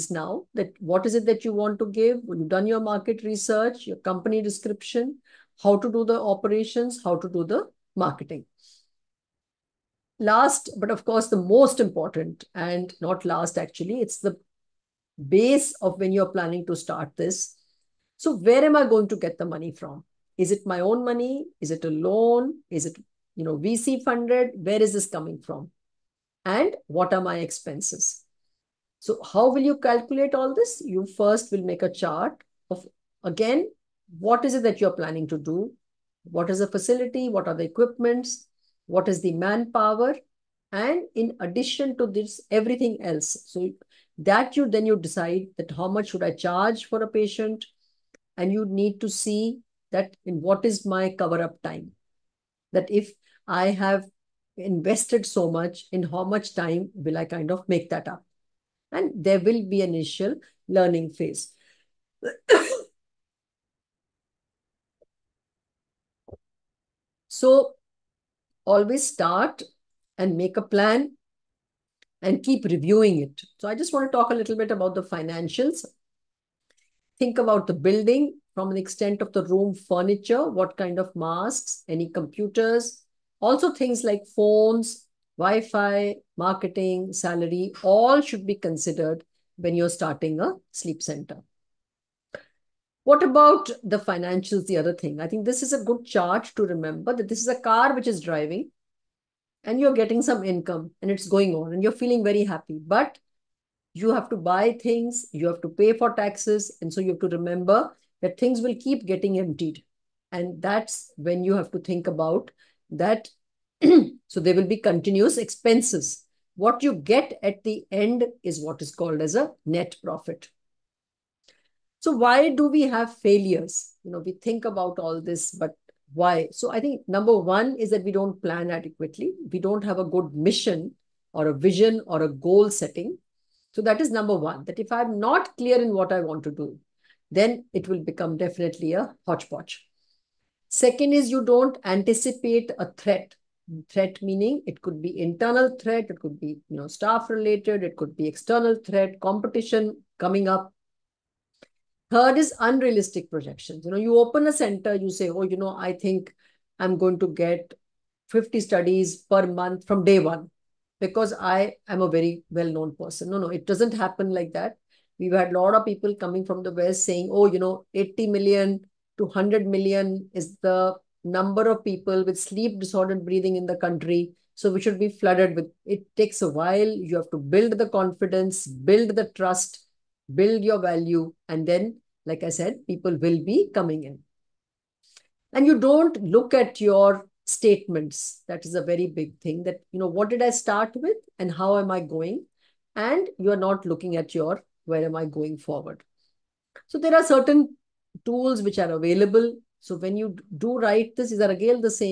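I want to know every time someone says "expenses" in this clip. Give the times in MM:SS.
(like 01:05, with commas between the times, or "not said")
00:27, 01:55.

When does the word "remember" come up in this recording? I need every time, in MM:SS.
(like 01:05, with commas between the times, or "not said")
01:36, 01:47.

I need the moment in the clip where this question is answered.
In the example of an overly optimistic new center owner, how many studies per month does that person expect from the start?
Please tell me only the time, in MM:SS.
02:38.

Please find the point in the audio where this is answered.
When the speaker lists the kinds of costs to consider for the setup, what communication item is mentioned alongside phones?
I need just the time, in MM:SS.
01:25.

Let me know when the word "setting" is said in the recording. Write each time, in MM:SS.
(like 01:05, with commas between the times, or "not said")
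02:12.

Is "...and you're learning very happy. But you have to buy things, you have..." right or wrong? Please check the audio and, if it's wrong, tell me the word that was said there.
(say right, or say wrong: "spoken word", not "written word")
wrong: "feeling", not "learning".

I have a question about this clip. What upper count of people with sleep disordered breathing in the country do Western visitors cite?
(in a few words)
100 million.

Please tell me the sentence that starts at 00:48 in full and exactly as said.
And you need to see that in what is my cover up time?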